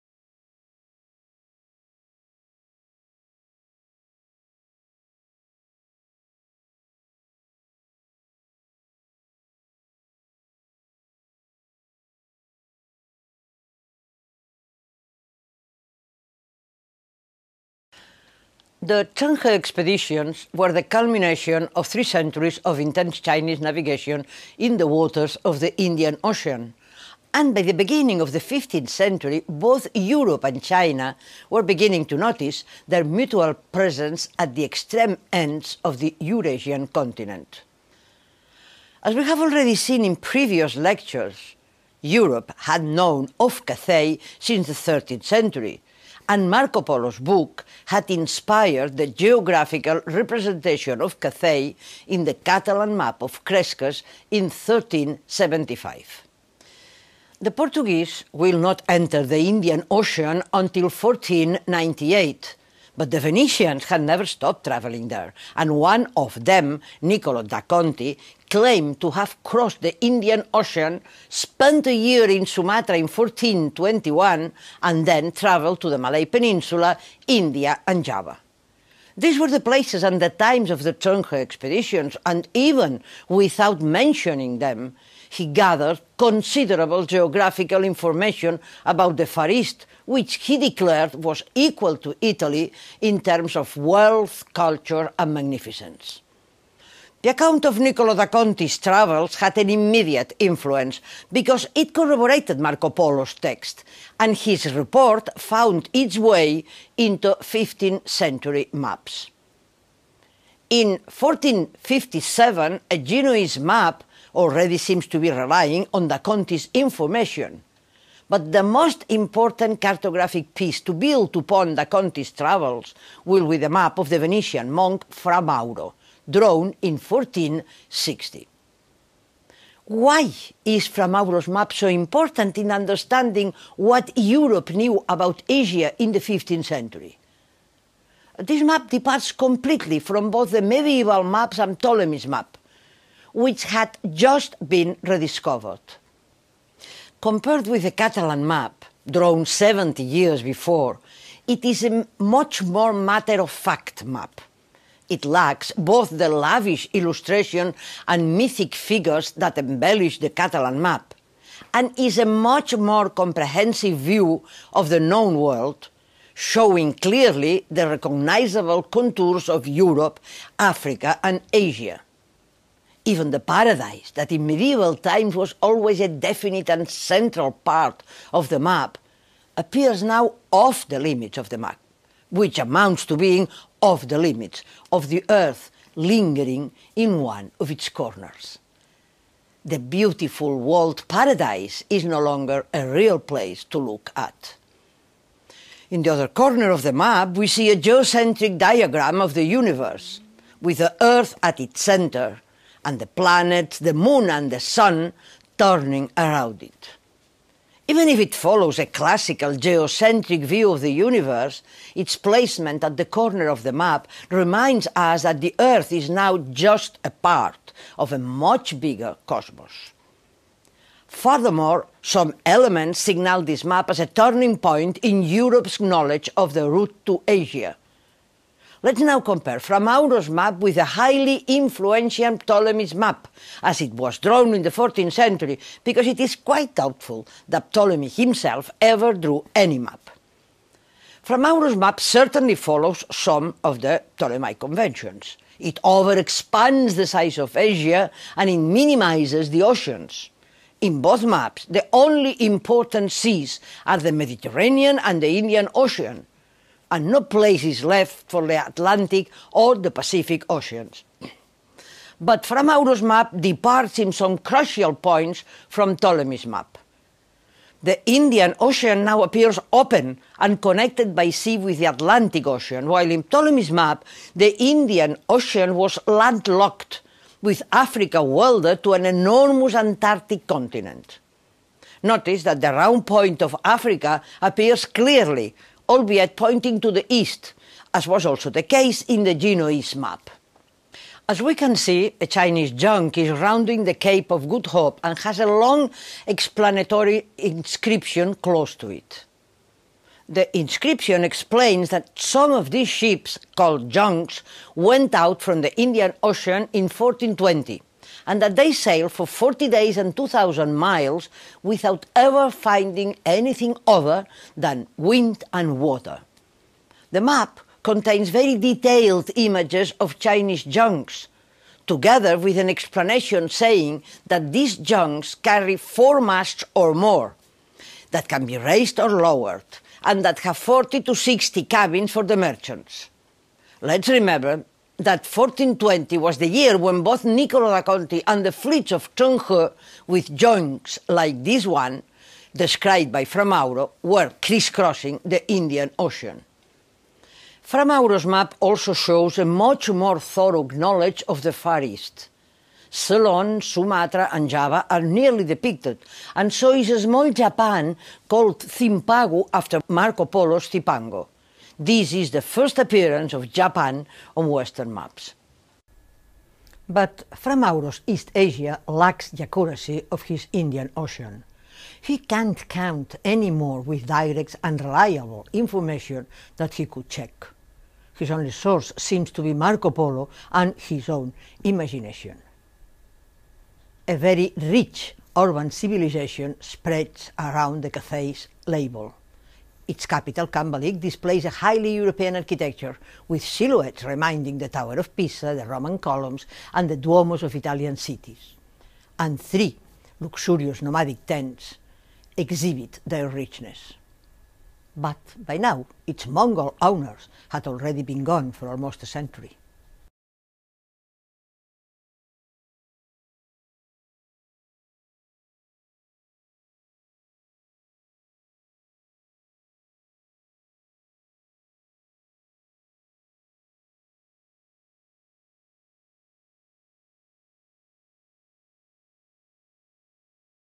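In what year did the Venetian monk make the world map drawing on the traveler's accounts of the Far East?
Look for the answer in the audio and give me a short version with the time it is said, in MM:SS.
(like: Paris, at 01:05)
1460, at 02:06.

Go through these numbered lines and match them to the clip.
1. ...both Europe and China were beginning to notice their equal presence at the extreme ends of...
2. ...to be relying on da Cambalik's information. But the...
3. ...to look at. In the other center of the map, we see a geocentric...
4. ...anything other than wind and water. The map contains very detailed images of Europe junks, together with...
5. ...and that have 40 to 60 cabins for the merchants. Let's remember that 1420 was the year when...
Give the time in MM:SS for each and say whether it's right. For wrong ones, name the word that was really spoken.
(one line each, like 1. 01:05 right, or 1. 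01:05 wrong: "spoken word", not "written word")
1. 00:29 wrong: "mutual", not "equal"
2. 01:55 wrong: "Conti", not "Cambalik"
3. 03:13 wrong: "corner", not "center"
4. 05:13 wrong: "Chinese", not "Europe"
5. 05:30 right.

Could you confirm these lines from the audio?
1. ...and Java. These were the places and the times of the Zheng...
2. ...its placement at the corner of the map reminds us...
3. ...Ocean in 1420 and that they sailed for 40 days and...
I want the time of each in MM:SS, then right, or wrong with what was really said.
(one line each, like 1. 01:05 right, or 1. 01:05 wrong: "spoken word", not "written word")
1. 01:17 right
2. 03:31 right
3. 05:06 right.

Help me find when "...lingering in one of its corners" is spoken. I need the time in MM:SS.
03:05.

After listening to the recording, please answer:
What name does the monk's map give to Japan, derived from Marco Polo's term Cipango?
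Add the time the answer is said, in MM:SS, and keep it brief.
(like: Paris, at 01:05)
Zimpagu, at 05:58.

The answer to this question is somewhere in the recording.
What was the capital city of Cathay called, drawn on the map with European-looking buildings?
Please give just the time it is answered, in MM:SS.
06:30.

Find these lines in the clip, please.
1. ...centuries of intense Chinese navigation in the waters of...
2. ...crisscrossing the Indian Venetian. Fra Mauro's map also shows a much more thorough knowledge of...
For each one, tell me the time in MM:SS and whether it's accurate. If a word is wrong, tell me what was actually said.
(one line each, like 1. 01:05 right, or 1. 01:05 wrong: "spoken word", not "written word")
1. 00:22 right
2. 05:44 wrong: "Ocean", not "Venetian".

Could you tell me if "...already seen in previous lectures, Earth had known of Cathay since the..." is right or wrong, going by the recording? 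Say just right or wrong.
wrong.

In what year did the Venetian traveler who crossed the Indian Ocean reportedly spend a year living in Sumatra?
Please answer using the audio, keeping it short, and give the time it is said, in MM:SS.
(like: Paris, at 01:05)
1421, at 01:13.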